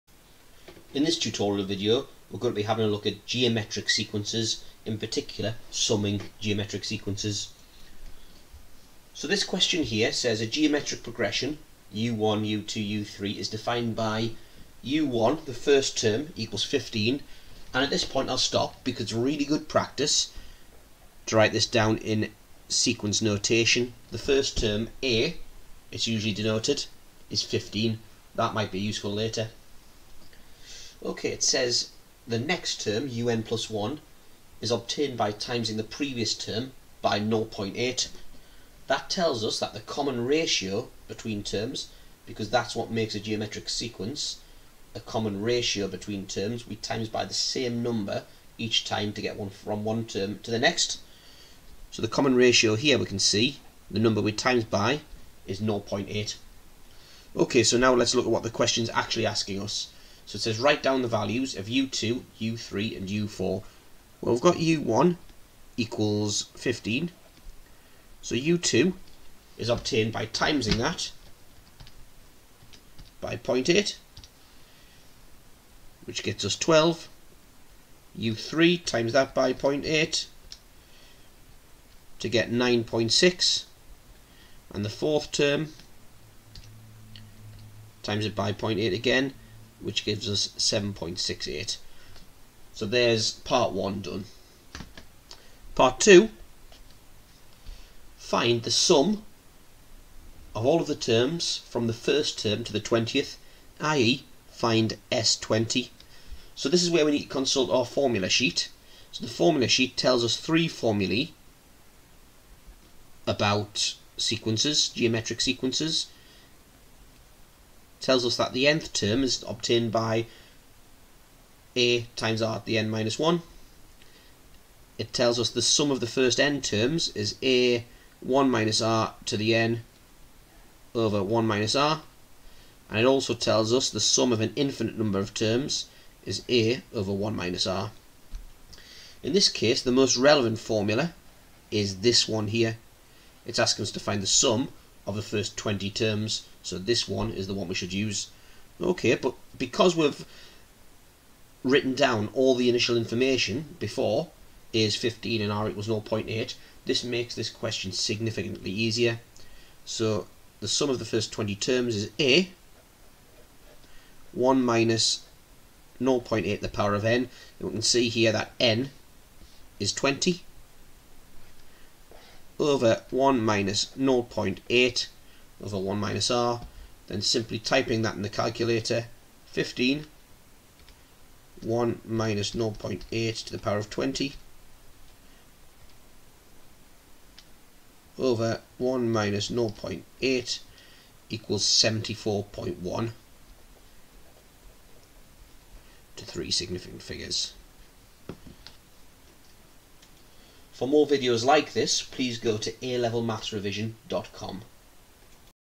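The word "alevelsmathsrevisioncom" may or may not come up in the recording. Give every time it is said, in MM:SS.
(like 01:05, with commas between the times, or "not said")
03:22.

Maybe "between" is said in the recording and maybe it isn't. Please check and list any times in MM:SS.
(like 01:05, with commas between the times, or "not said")
00:41, 00:45.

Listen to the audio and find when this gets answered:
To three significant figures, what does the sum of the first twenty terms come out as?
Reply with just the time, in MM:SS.
03:11.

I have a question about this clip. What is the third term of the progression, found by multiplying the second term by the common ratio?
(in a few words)
9.6.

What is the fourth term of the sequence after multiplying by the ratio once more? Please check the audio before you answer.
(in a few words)
7.68.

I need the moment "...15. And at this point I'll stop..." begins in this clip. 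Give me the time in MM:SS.
00:16.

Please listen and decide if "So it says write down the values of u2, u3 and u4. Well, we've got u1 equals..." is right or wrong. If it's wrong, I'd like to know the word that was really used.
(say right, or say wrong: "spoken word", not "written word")
right.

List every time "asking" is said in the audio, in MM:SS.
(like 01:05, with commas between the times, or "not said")
00:59, 02:23.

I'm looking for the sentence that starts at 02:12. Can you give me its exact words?
And it also tells us the sum of an infinite number of terms is a over 1 minus r.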